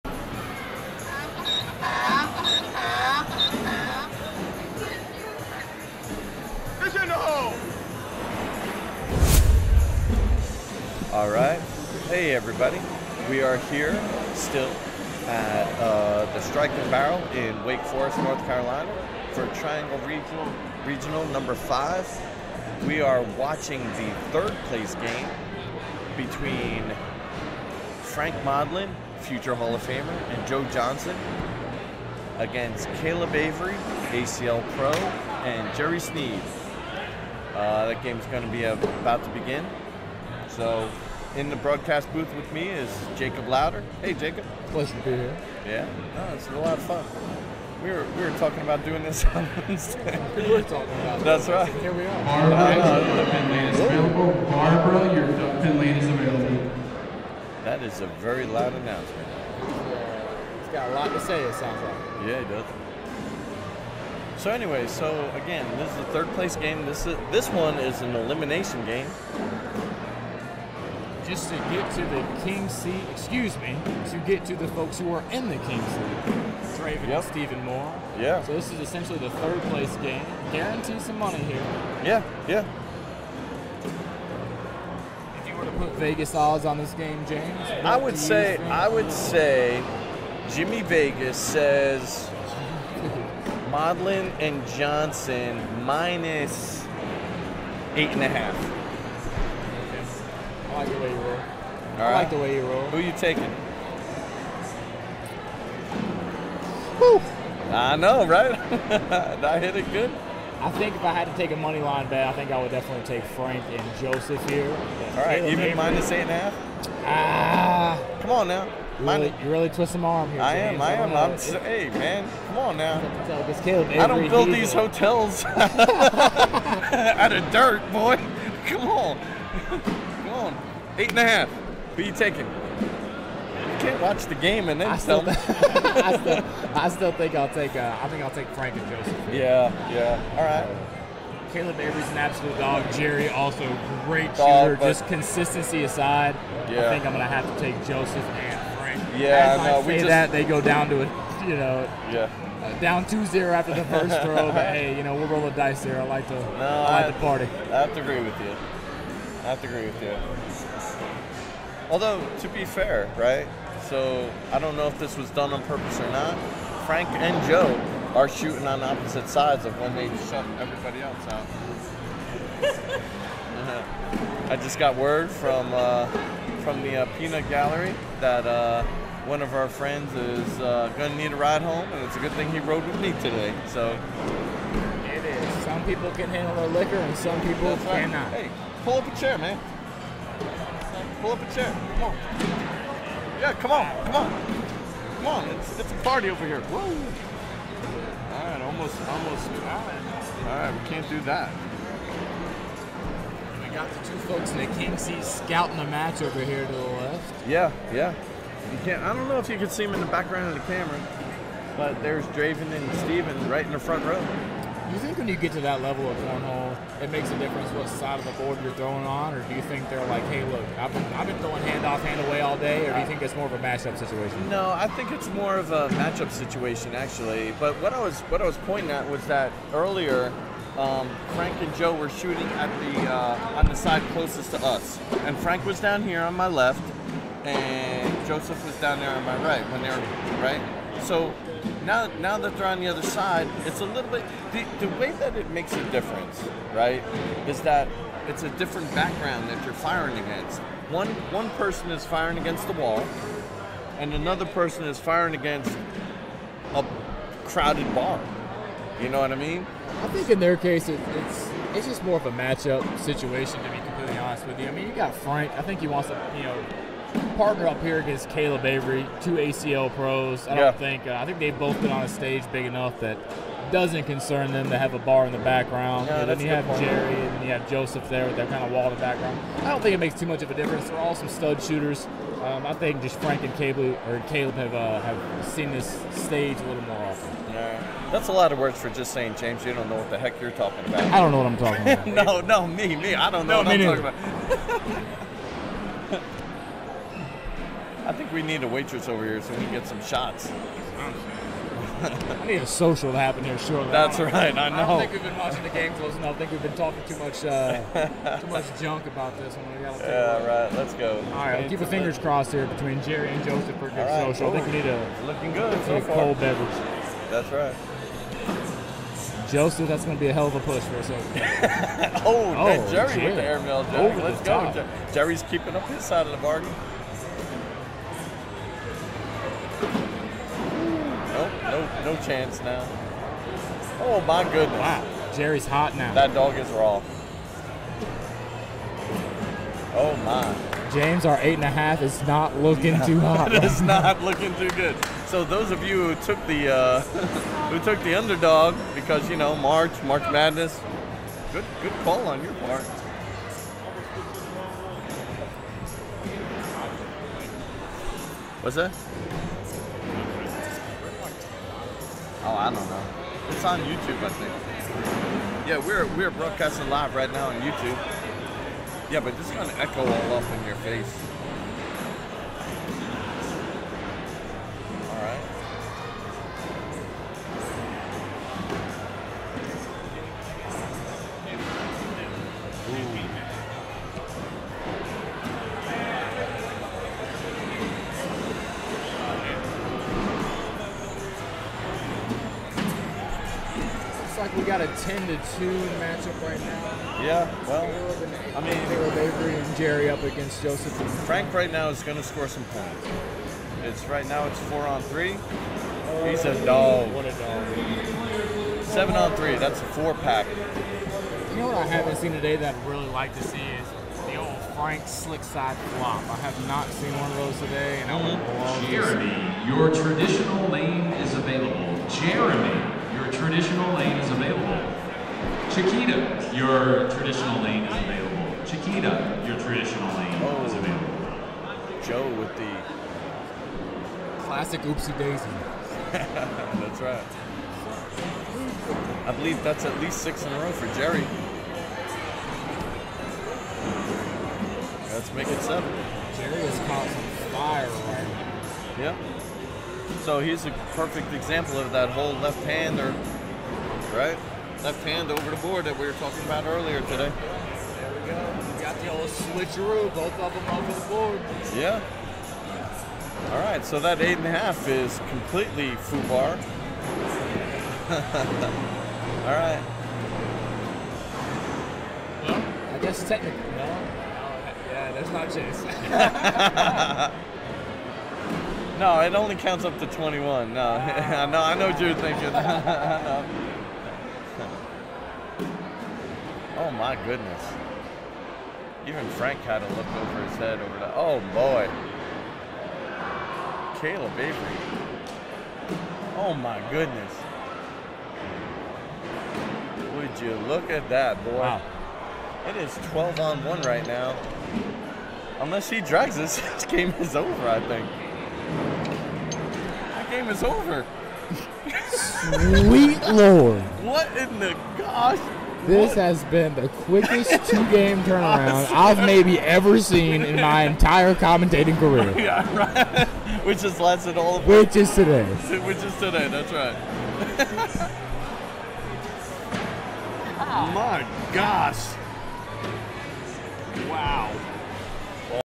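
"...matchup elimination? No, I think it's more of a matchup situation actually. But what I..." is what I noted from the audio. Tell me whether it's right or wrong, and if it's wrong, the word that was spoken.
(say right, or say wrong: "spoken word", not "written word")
wrong: "situation", not "elimination".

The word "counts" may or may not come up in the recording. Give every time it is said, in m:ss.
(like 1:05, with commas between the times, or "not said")
7:59.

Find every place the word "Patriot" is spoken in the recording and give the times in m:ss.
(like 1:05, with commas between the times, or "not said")
not said.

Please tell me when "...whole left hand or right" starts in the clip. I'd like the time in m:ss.
7:32.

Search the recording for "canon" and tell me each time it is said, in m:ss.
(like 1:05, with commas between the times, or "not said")
not said.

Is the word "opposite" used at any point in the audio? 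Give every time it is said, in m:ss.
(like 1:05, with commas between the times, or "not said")
2:48.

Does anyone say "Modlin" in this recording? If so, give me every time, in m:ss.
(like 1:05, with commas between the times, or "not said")
0:28, 1:33.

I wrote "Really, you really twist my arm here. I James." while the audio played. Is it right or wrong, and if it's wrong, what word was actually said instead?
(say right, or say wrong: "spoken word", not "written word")
right.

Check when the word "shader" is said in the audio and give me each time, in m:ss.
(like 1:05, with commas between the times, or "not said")
not said.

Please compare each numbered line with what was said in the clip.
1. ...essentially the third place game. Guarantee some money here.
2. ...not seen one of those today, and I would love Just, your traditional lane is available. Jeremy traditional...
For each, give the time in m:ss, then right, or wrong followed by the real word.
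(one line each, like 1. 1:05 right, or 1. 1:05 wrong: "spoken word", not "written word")
1. 1:18 right
2. 6:56 wrong: "Jeremy", not "Just".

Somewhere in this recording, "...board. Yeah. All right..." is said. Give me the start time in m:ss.
7:41.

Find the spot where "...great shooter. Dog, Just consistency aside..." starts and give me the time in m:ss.
2:24.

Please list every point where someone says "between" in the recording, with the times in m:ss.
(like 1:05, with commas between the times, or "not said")
0:26, 5:12.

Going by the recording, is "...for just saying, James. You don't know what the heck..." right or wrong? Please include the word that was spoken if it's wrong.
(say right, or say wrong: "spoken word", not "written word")
right.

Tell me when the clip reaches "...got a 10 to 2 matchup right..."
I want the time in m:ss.
6:34.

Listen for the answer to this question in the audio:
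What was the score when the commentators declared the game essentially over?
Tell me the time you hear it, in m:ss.
8:23.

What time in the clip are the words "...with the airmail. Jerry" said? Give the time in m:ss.
5:23.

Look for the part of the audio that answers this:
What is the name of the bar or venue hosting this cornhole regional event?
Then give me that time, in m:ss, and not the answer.
0:16.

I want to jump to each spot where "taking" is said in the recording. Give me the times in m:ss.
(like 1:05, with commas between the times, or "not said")
1:43, 2:12.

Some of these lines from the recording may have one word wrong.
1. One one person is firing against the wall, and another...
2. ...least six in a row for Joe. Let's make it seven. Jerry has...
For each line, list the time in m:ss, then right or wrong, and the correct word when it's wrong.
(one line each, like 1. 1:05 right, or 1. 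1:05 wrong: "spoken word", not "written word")
1. 4:10 right
2. 7:20 wrong: "Jerry", not "Joe".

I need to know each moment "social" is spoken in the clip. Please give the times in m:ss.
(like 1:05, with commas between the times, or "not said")
5:02, 5:14.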